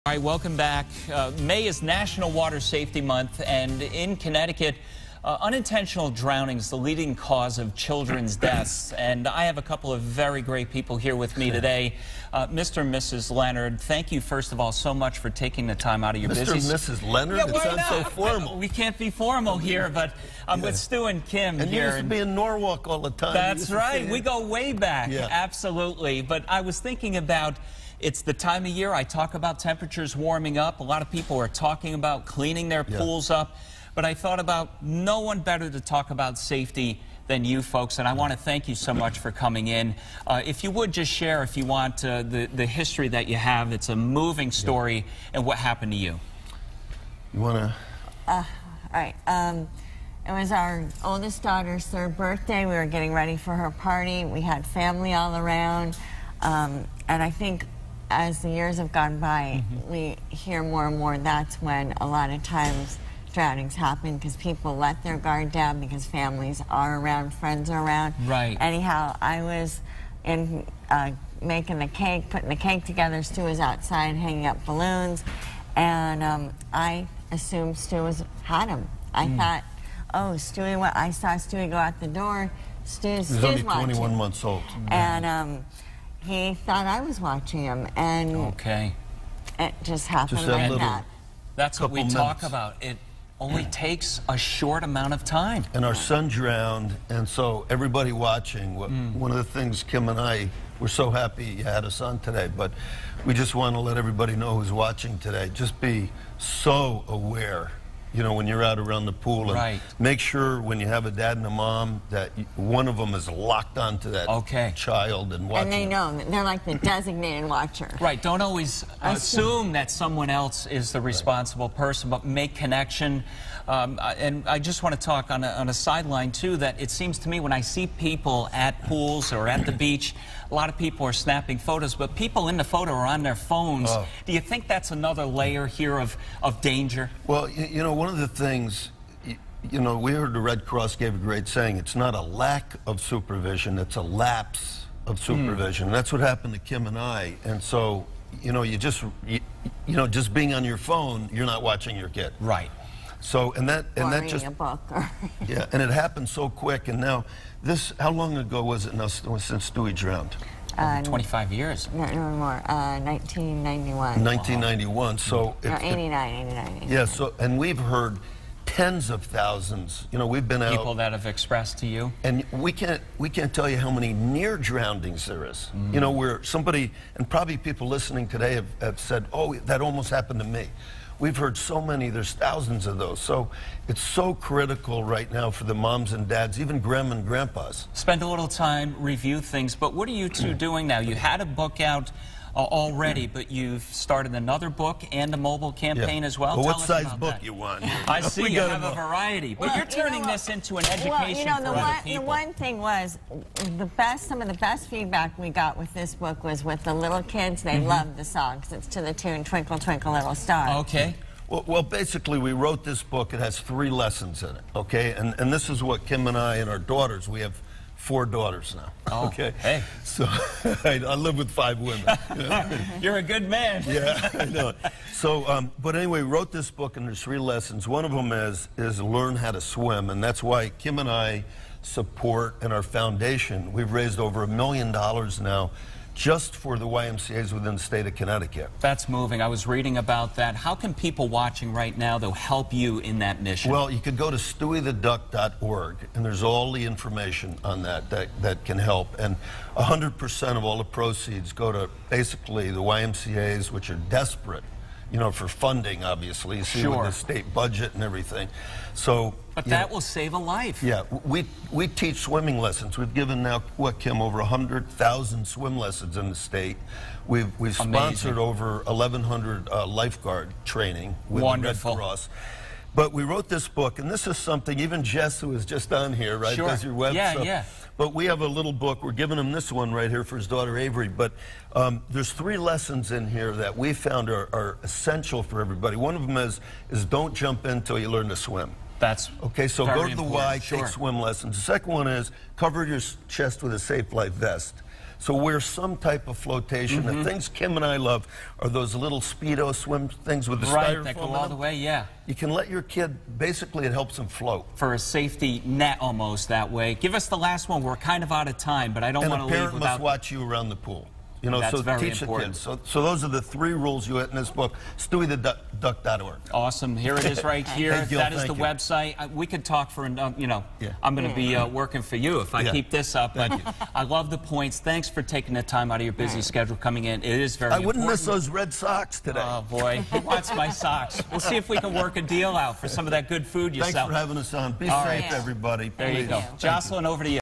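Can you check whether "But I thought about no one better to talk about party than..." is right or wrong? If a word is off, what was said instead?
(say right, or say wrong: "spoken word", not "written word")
wrong: "safety", not "party".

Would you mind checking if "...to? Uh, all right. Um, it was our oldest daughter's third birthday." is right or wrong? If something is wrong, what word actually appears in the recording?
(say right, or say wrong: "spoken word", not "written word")
right.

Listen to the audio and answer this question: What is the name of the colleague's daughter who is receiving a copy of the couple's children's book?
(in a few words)
Avery.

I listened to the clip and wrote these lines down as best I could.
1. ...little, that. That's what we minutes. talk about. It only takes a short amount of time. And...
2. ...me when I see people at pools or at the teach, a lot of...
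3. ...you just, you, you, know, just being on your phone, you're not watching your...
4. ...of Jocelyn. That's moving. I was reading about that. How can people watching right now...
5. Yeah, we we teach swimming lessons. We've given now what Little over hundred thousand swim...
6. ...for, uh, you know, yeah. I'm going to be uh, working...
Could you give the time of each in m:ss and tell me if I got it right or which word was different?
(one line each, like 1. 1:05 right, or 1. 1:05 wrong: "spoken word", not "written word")
1. 1:30 right
2. 2:07 wrong: "beach", not "teach"
3. 2:28 right
4. 3:58 wrong: "Connecticut", not "Jocelyn"
5. 4:20 wrong: "Kim", not "Little"
6. 5:19 right.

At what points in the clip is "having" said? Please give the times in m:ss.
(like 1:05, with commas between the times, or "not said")
5:34.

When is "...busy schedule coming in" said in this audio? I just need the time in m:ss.
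5:26.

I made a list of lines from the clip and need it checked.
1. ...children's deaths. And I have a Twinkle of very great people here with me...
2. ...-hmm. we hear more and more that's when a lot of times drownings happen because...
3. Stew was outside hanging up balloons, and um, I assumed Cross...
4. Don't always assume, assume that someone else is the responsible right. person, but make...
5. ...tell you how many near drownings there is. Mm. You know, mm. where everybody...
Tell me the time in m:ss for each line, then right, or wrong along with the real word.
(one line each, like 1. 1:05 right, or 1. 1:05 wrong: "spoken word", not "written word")
1. 0:07 wrong: "couple", not "Twinkle"
2. 0:59 right
3. 1:13 wrong: "Stew", not "Cross"
4. 1:58 right
5. 2:53 wrong: "somebody", not "everybody".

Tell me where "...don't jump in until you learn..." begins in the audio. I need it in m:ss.
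4:47.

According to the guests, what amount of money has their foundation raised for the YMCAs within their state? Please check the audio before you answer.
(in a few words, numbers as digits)
Over a million dollars.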